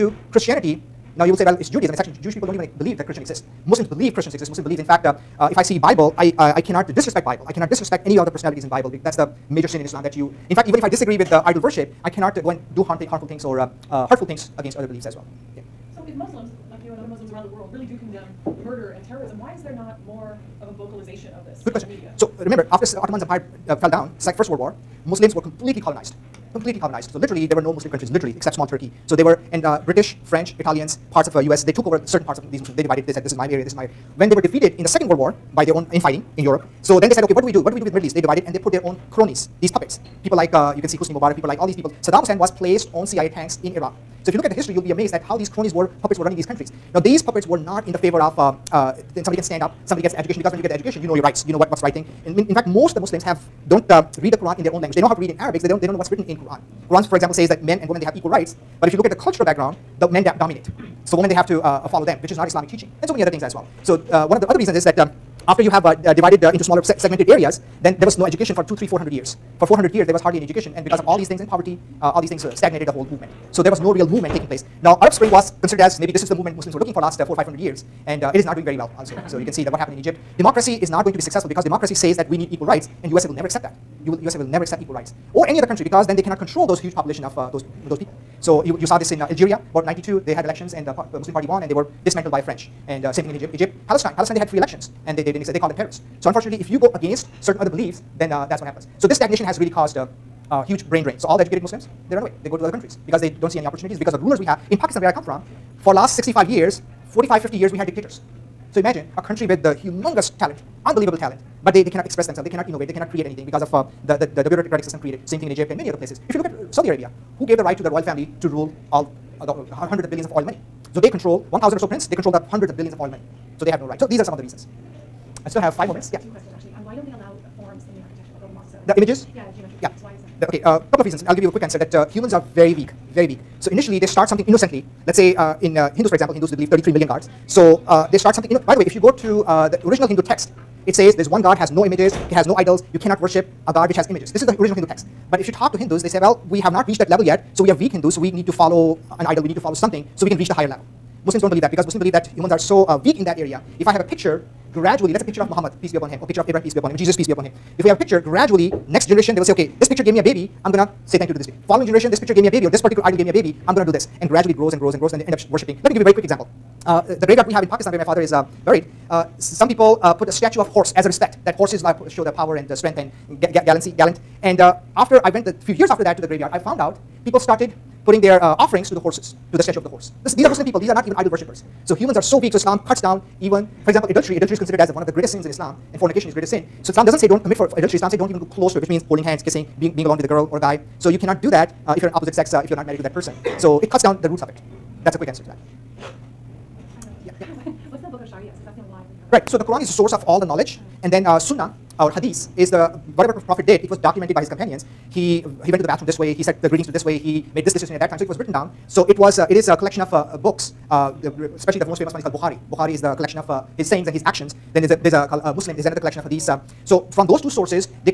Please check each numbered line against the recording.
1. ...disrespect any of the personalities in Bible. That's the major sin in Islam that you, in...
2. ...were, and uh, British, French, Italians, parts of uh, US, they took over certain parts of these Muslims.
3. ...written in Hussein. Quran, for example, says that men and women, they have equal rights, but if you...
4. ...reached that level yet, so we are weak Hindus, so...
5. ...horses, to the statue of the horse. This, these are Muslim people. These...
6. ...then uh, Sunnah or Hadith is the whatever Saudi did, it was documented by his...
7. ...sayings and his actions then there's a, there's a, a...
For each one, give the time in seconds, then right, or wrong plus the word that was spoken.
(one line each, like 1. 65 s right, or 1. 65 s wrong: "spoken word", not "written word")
1. 7 s right
2. 29 s right
3. 56 s wrong: "Quran", not "Hussein"
4. 146 s right
5. 178 s right
6. 201 s wrong: "Prophet", not "Saudi"
7. 213 s right.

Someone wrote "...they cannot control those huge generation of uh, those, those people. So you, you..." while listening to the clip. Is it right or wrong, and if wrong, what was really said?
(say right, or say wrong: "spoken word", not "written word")
wrong: "population", not "generation".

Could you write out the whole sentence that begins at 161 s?
Following generation, this picture gave me a baby, or this particular idol gave me a baby, I'm going to do this.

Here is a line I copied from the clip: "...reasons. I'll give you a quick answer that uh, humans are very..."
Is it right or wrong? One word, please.
right.